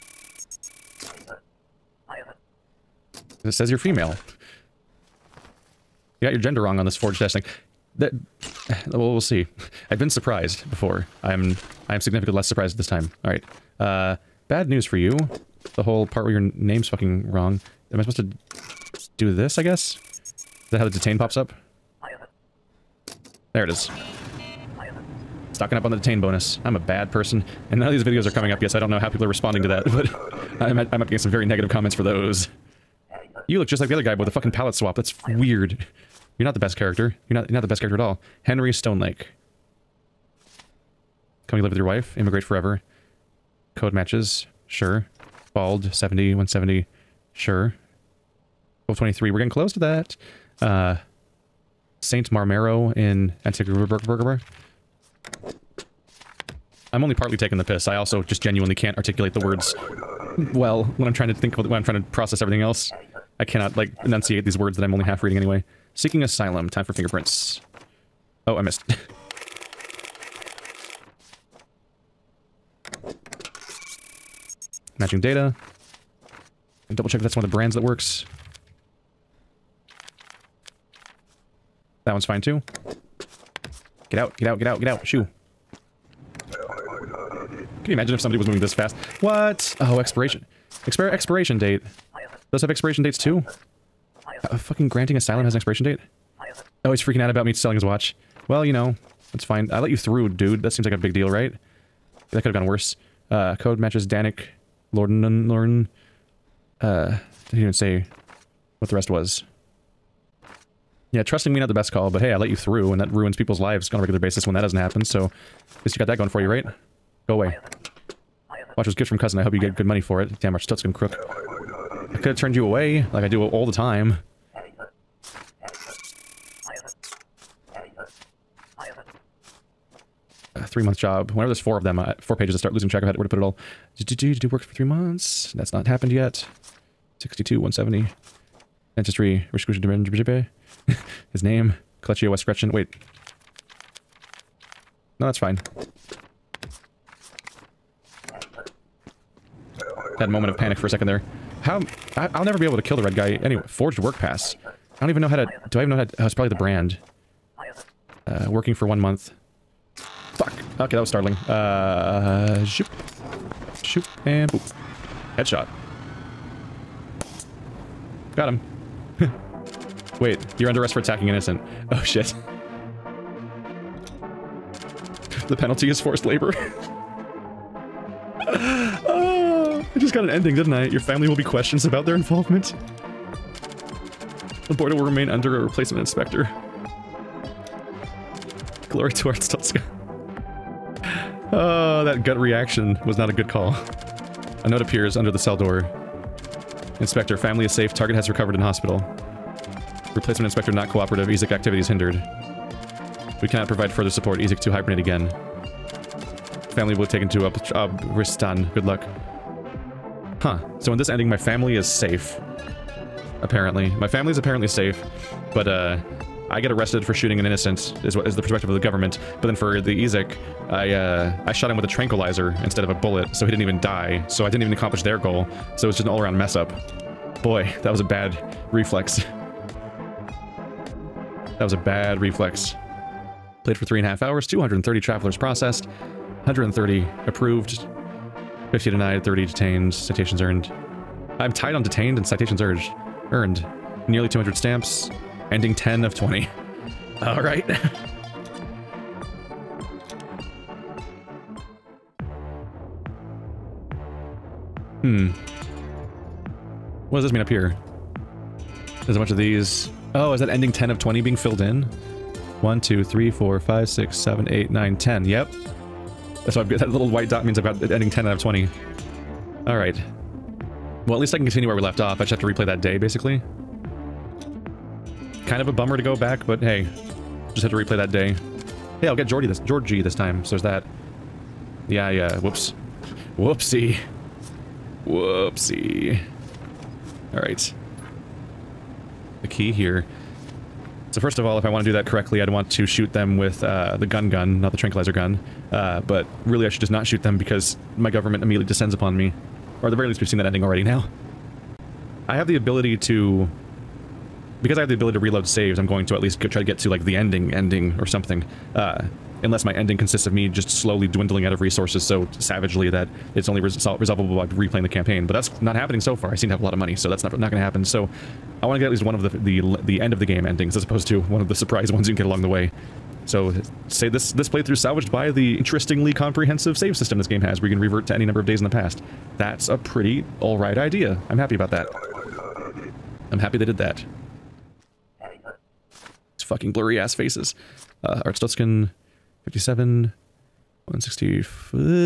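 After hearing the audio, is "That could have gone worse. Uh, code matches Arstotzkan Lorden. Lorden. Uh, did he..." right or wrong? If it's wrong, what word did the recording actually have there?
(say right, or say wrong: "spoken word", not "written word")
wrong: "Danik", not "Arstotzkan".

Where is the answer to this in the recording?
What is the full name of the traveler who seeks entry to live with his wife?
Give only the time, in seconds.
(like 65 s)
38 s.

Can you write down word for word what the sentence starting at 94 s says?
A fucking granting asylum has an expiration date?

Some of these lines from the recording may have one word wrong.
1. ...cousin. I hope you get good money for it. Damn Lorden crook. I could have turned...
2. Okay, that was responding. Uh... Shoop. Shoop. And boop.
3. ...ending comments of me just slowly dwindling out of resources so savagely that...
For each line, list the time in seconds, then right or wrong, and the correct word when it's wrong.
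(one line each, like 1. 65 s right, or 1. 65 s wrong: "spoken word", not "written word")
1. 119 s wrong: "Arstotzkan", not "Lorden"
2. 160 s wrong: "startling", not "responding"
3. 309 s wrong: "consists", not "comments".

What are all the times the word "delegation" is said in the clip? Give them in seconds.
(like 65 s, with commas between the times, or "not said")
not said.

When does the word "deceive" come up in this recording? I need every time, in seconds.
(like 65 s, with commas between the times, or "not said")
not said.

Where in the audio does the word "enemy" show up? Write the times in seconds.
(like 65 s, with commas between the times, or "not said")
not said.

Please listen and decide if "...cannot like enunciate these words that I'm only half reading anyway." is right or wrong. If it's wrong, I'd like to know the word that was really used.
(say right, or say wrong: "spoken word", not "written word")
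right.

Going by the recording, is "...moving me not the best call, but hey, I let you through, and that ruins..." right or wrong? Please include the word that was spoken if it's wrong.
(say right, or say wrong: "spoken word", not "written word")
wrong: "trusting", not "moving".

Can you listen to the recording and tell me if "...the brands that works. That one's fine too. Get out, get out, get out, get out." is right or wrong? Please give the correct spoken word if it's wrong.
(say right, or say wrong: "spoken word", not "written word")
right.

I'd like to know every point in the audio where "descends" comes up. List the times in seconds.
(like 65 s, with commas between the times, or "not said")
298 s.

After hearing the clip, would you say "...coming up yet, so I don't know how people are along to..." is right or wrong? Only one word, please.
wrong.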